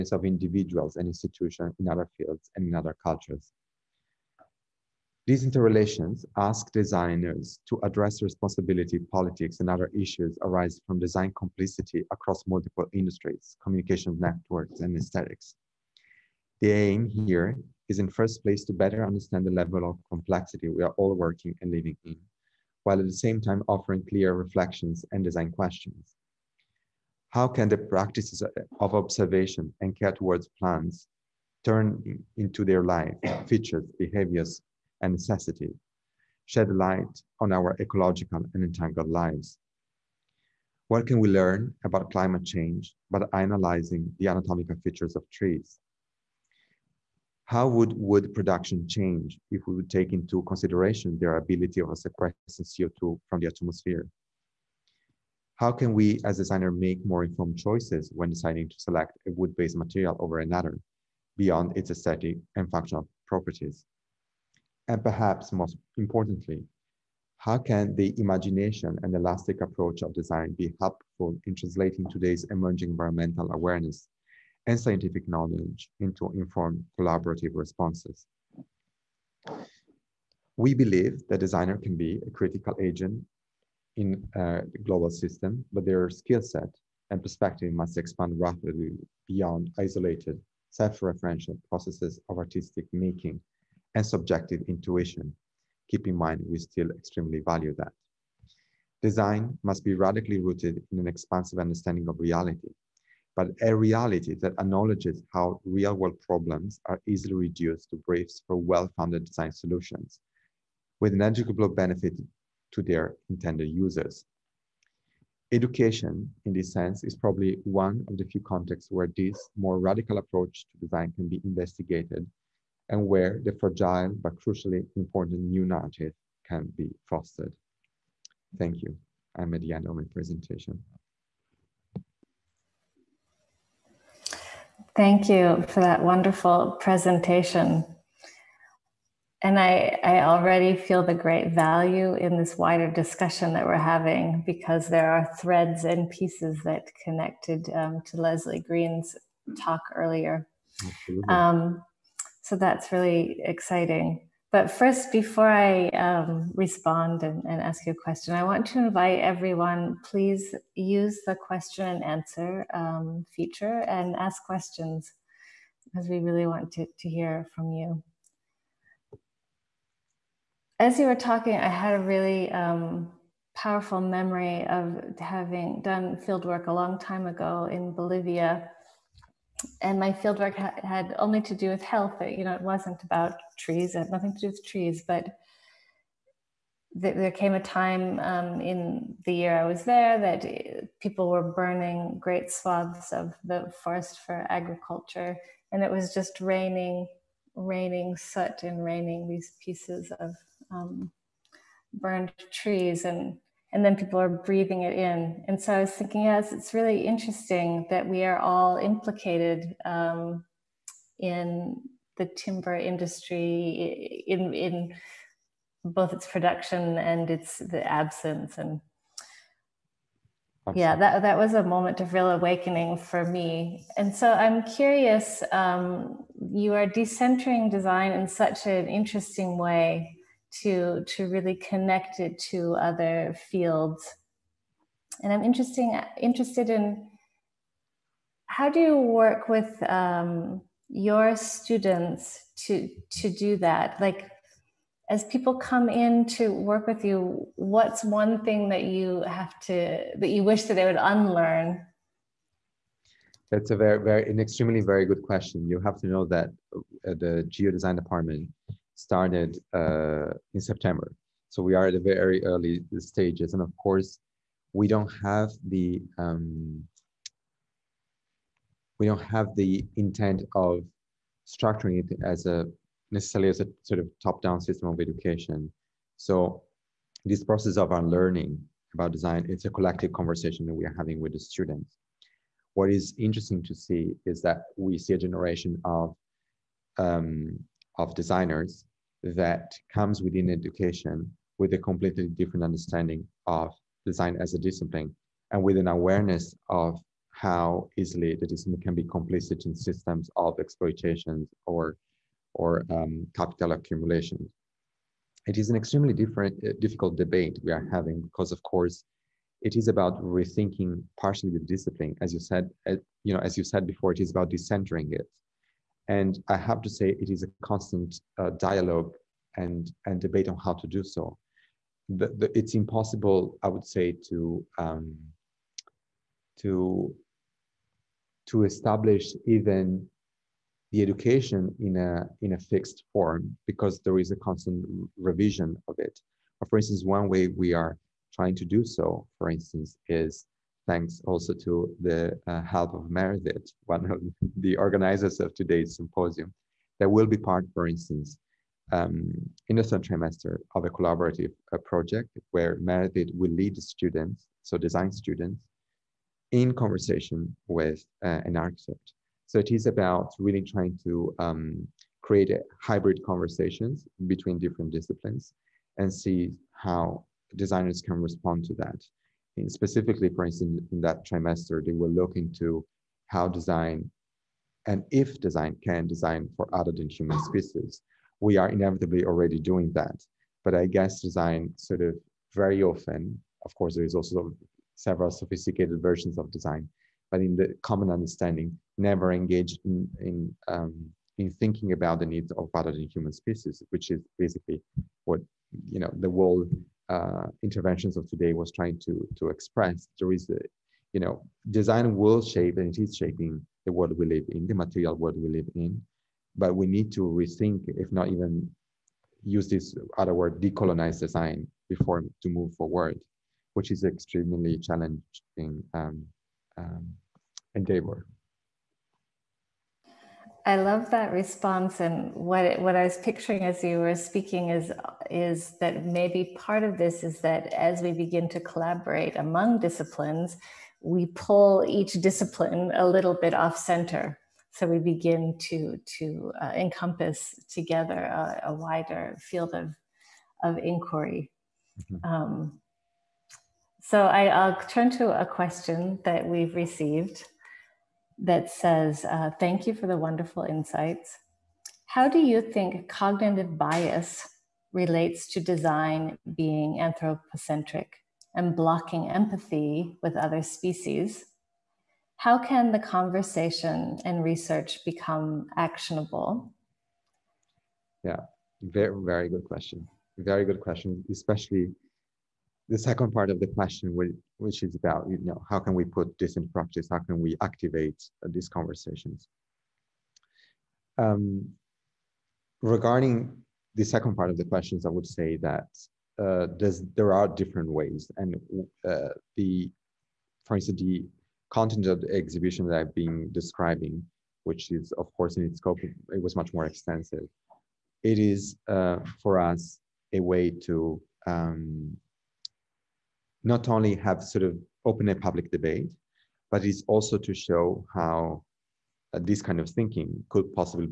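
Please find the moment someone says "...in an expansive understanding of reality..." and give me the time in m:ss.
1:40.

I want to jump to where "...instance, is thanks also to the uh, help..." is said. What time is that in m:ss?
5:39.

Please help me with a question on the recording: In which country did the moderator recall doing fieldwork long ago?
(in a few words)
Bolivia.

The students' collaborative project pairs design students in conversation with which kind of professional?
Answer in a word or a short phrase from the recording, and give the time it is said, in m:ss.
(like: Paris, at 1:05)
an architect, at 5:58.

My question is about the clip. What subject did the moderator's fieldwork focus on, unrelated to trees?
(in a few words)
health.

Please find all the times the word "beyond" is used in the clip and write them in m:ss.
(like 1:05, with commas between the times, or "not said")
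1:01, 1:29.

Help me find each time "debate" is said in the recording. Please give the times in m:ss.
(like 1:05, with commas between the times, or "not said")
5:07, 5:20, 8:25.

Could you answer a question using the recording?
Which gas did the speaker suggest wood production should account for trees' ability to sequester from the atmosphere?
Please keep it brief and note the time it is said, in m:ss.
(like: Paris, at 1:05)
CO2, at 0:52.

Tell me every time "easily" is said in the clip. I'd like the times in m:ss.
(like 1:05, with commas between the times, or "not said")
1:47, 4:57.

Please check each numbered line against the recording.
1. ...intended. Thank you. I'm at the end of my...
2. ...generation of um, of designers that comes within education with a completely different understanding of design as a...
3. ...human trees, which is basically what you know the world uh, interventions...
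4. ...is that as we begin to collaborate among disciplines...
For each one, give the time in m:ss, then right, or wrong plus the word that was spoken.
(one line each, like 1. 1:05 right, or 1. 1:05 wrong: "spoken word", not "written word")
1. 2:07 wrong: "fostered", not "intended"
2. 4:45 right
3. 6:33 wrong: "species", not "trees"
4. 7:07 right.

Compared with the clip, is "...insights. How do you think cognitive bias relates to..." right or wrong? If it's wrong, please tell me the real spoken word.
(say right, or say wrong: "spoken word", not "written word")
right.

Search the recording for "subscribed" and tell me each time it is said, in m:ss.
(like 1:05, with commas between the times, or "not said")
not said.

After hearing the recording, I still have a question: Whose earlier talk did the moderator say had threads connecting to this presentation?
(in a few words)
Leslie Green.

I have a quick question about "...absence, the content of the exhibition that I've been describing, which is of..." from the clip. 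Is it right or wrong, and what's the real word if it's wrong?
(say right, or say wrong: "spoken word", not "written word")
wrong: "instance", not "absence".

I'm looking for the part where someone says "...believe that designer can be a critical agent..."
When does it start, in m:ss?
1:20.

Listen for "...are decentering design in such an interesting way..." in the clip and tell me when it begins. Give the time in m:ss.
3:46.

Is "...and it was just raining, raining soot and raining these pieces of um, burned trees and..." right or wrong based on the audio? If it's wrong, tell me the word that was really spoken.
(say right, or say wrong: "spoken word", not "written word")
right.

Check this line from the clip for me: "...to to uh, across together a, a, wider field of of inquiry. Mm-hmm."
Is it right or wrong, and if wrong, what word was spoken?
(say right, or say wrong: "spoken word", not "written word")
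wrong: "encompass", not "across".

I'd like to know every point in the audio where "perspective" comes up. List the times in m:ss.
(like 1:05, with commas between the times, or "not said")
1:27.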